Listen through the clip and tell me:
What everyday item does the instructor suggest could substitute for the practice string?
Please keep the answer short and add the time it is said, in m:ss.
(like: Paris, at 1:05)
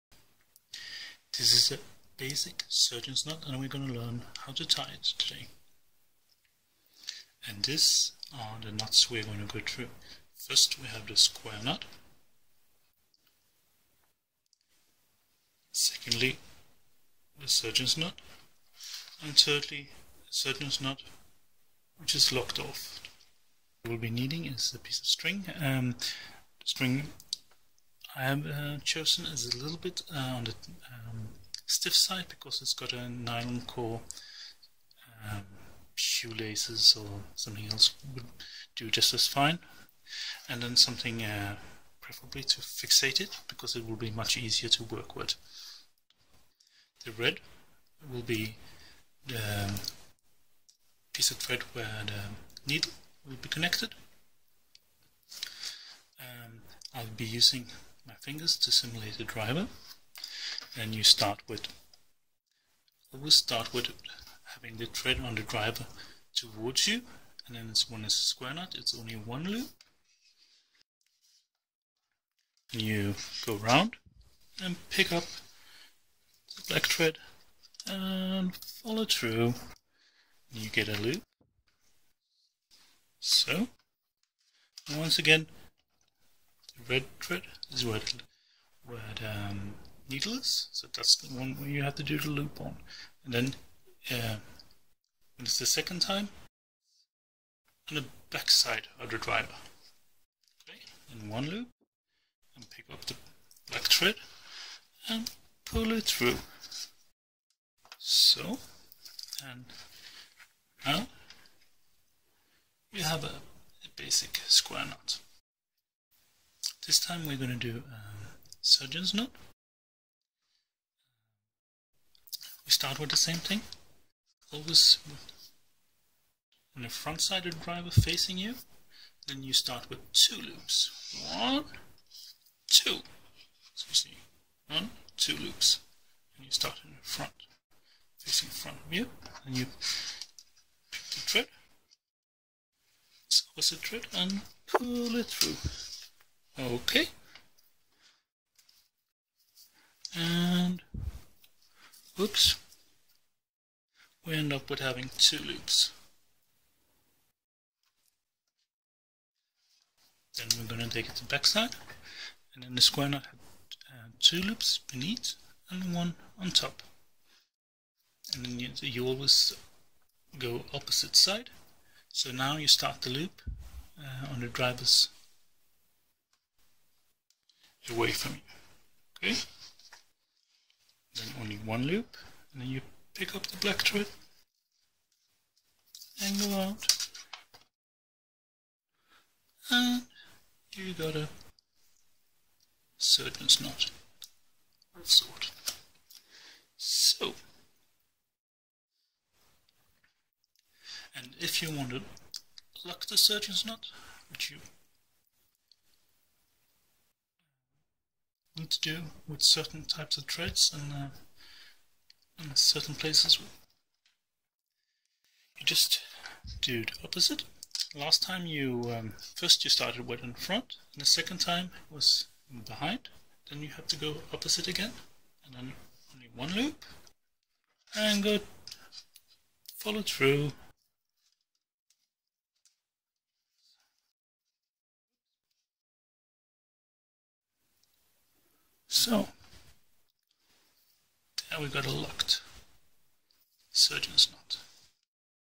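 shoelaces, at 0:35.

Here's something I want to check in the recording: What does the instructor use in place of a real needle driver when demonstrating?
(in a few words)
fingers.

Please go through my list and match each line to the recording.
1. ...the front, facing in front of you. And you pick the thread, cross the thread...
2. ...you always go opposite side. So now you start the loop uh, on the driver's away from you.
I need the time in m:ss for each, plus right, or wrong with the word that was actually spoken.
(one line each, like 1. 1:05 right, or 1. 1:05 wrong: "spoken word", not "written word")
1. 2:16 right
2. 2:48 right.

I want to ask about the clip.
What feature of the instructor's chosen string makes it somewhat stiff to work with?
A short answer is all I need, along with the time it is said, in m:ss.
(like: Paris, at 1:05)
nylon core, at 0:33.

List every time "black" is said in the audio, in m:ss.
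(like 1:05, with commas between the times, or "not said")
1:16, 1:43, 3:03.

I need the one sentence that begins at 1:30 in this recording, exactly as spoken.
So that's the one where you have to do the loop on.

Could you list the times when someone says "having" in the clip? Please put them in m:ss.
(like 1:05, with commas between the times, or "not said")
1:04, 2:34.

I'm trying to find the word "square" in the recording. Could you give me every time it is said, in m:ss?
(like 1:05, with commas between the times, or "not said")
0:11, 1:08, 1:54, 2:42.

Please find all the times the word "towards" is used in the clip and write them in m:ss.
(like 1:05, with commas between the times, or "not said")
1:06.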